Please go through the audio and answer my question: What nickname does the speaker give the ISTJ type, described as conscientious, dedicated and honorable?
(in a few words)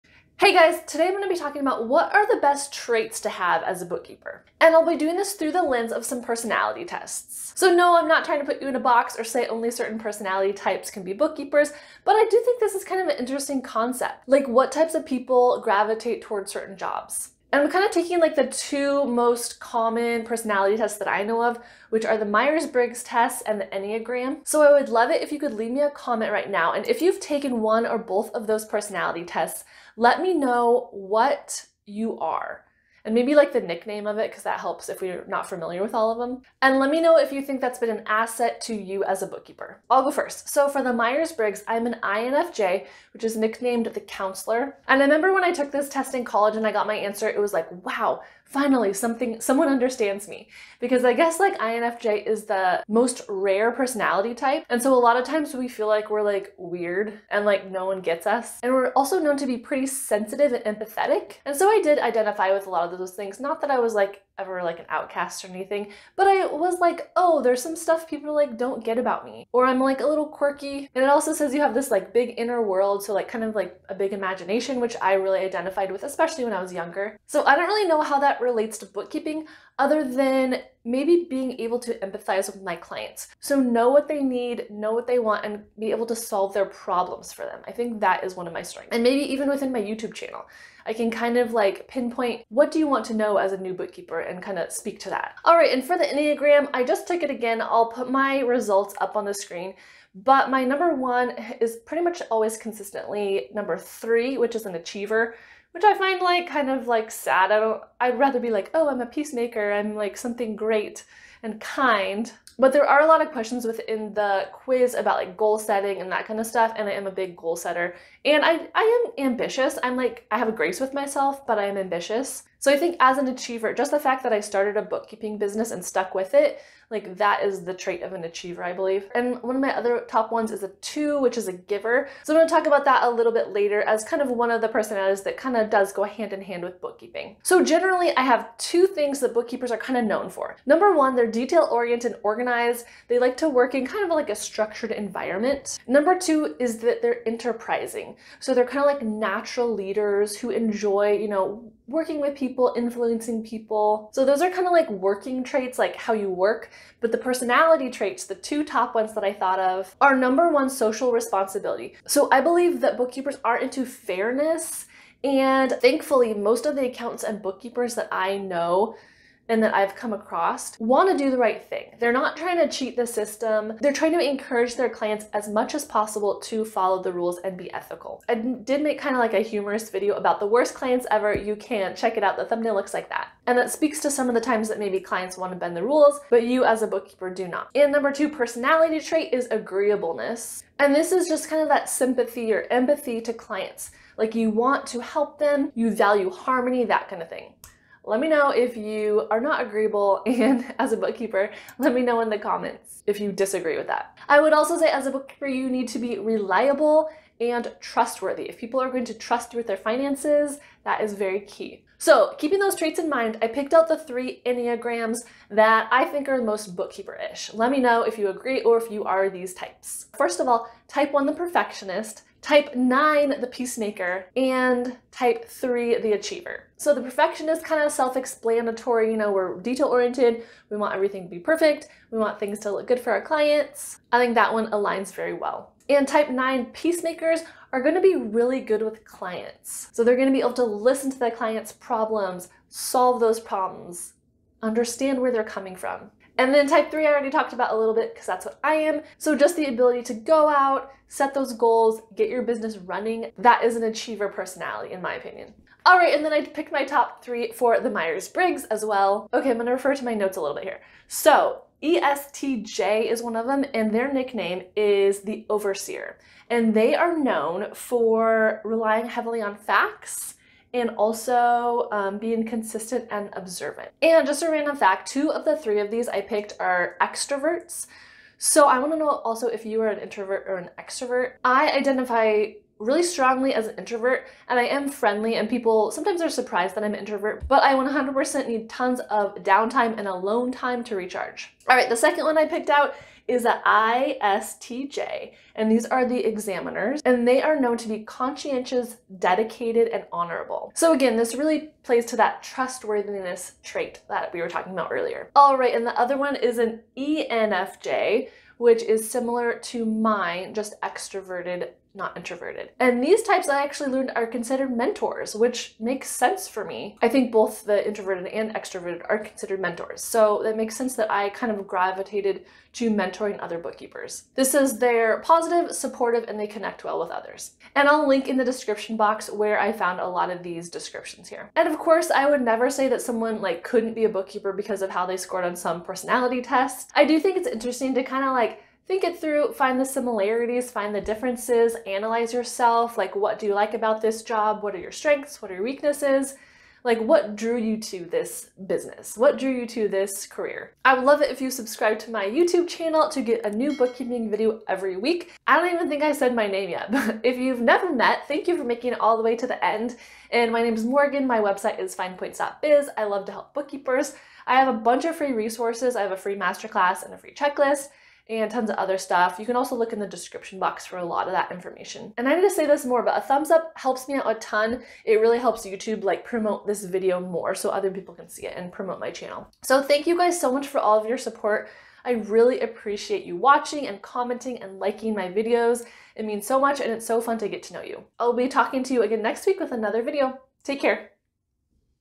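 Examiners.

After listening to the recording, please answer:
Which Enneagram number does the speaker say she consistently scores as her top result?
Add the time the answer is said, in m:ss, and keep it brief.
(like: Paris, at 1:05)
3, at 1:43.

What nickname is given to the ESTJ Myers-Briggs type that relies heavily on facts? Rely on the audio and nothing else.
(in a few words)
The Overseer.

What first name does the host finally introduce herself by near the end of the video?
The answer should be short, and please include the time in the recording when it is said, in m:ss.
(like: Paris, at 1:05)
Morgan, at 6:00.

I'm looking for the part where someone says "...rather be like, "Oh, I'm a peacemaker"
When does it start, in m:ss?
1:48.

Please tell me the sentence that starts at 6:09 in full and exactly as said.
You can also look in the description box for a lot of that information.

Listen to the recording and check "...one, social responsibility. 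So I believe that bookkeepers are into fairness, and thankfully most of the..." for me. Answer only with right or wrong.
right.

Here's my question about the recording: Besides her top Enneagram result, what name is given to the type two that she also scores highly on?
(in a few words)
Giver.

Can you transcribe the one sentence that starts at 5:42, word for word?
Like, what do you like about this job?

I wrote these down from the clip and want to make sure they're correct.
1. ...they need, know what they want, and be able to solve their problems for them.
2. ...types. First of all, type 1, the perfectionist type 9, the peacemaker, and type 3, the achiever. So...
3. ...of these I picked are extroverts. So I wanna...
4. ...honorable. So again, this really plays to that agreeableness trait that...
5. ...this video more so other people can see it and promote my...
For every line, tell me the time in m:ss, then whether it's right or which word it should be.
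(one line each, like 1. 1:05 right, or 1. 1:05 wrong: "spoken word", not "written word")
1. 1:24 right
2. 3:39 right
3. 4:35 right
4. 5:00 wrong: "trustworthiness", not "agreeableness"
5. 6:16 right.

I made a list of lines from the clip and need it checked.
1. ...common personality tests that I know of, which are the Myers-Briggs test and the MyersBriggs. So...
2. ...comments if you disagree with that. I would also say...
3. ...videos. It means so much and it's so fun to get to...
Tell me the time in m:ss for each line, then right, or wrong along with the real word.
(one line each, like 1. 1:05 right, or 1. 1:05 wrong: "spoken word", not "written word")
1. 0:19 wrong: "Enneagram", not "MyersBriggs"
2. 3:22 right
3. 6:25 right.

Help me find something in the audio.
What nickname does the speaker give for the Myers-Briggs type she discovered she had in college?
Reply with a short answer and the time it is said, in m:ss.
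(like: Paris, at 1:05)
The counselor, at 0:43.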